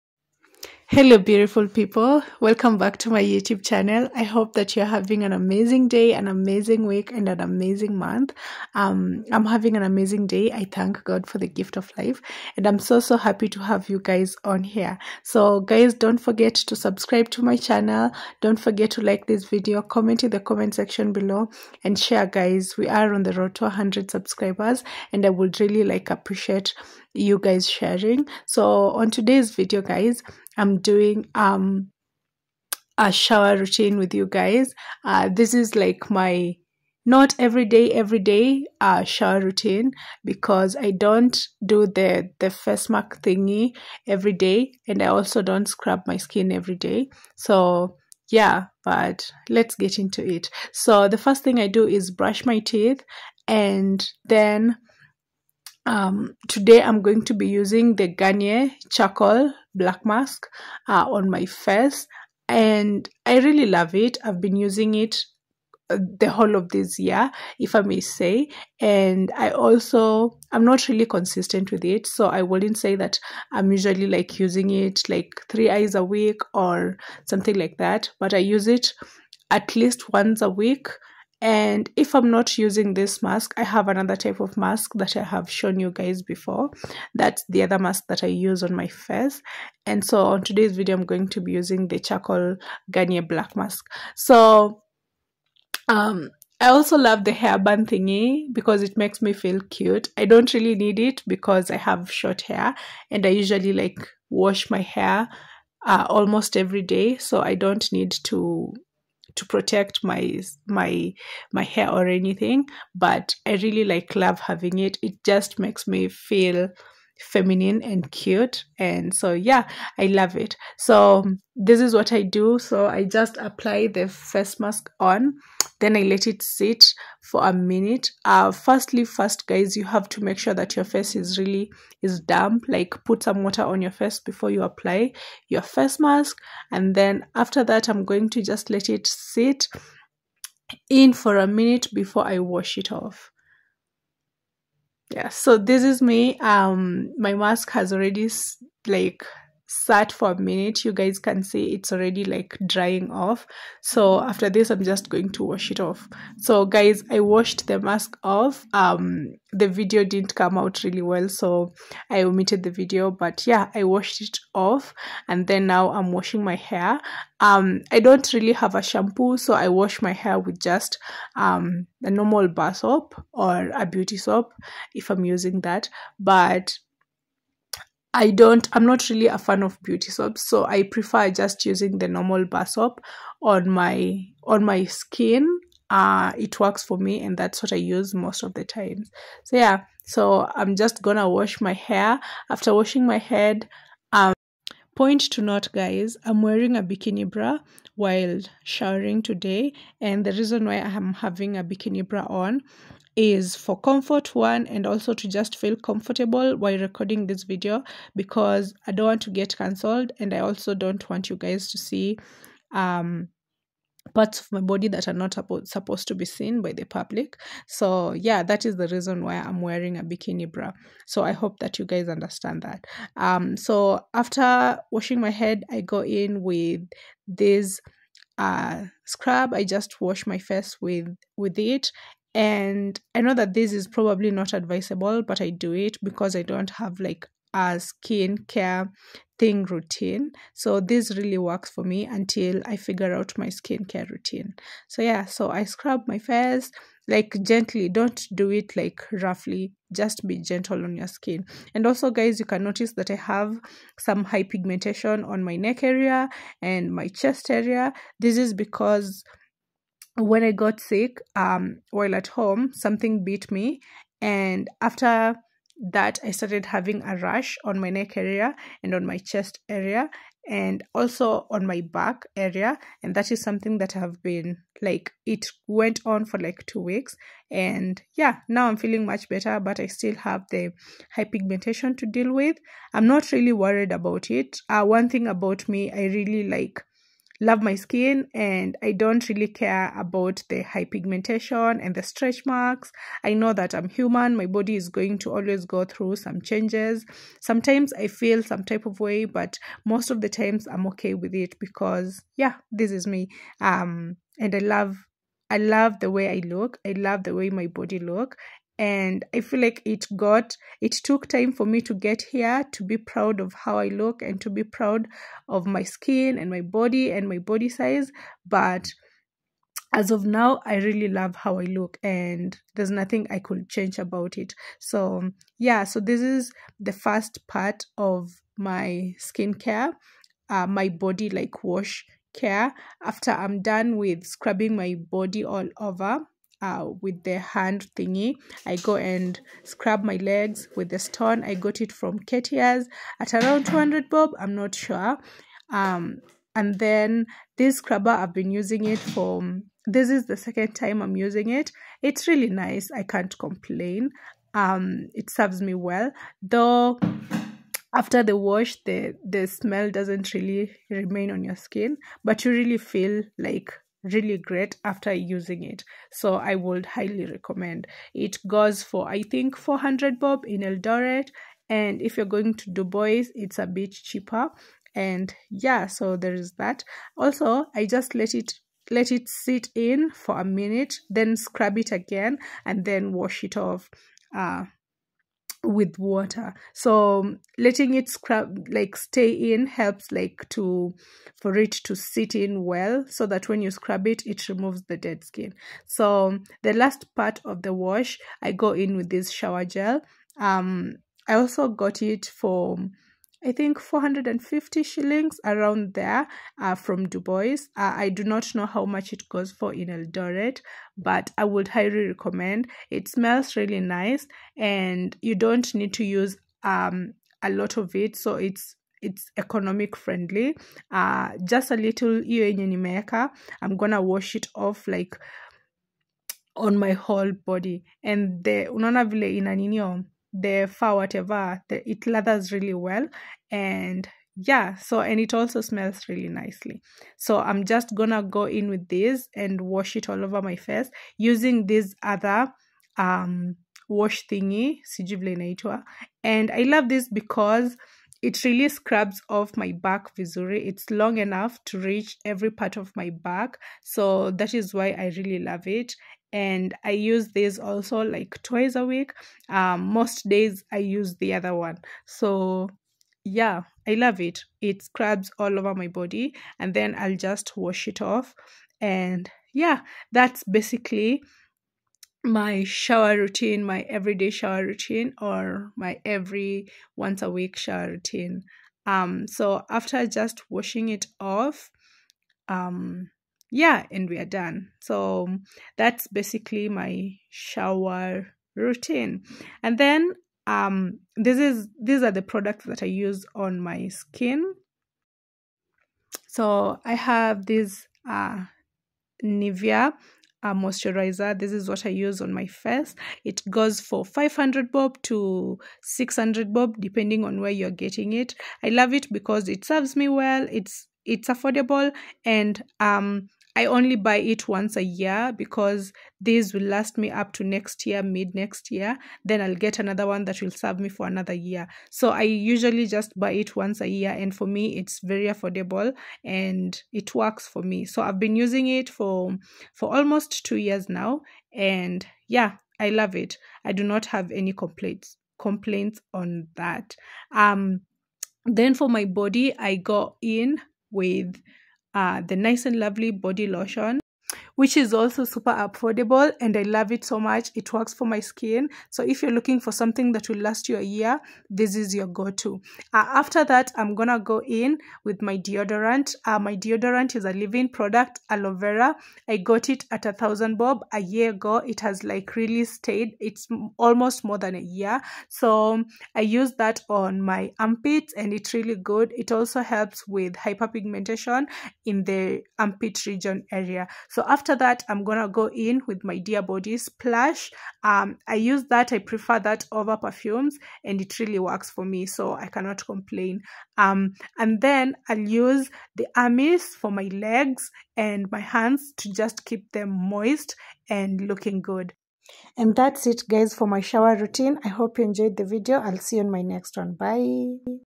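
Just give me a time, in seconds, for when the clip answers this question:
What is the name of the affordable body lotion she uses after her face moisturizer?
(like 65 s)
542 s.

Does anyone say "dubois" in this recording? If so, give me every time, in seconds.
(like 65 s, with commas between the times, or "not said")
372 s, 407 s.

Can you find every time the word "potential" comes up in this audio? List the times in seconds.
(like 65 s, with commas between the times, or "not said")
not said.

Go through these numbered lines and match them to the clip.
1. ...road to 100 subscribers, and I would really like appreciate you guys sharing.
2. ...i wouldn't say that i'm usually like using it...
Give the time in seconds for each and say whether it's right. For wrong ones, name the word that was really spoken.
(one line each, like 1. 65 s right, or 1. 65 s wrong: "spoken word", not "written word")
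1. 23 s right
2. 72 s right.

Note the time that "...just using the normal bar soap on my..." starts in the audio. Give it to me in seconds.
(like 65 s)
181 s.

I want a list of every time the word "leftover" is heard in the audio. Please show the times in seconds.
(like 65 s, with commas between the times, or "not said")
not said.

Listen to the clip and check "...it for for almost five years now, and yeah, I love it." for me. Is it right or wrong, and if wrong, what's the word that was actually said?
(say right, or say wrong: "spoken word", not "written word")
wrong: "two", not "five".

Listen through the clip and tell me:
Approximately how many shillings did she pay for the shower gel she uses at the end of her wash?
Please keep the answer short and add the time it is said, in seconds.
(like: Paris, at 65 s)
450 shillings, at 403 s.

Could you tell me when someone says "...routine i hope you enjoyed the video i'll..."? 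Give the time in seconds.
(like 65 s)
594 s.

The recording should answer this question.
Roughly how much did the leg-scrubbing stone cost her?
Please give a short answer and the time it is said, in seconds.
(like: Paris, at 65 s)
200 bob, at 343 s.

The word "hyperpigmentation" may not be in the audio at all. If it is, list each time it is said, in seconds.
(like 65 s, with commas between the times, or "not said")
254 s, 281 s, 290 s, 570 s.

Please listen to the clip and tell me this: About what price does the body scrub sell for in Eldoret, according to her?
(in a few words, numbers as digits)
400 bob.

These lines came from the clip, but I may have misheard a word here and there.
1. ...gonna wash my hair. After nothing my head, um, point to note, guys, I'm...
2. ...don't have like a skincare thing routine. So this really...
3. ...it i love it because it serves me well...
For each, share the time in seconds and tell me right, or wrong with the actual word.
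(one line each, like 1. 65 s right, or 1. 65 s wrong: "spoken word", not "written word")
1. 191 s wrong: "washing", not "nothing"
2. 236 s right
3. 508 s right.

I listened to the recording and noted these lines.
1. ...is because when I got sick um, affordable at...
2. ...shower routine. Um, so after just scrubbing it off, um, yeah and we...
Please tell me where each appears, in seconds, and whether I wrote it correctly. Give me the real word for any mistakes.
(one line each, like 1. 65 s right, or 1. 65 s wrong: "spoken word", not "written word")
1. 258 s wrong: "while", not "affordable"
2. 477 s wrong: "washing", not "scrubbing".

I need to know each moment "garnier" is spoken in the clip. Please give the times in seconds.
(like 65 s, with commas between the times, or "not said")
58 s, 92 s.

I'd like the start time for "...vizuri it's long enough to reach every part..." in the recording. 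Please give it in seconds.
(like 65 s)
450 s.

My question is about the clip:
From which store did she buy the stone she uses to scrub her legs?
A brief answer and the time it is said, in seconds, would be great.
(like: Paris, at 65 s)
Khetia's, at 342 s.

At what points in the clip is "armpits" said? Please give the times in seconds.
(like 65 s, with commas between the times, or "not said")
567 s, 572 s.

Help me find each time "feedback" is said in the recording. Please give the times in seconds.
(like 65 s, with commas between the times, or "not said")
not said.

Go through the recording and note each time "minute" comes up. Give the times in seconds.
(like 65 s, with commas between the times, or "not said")
127 s, 141 s, 150 s, 380 s.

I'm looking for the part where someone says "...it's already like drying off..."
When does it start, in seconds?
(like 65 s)
151 s.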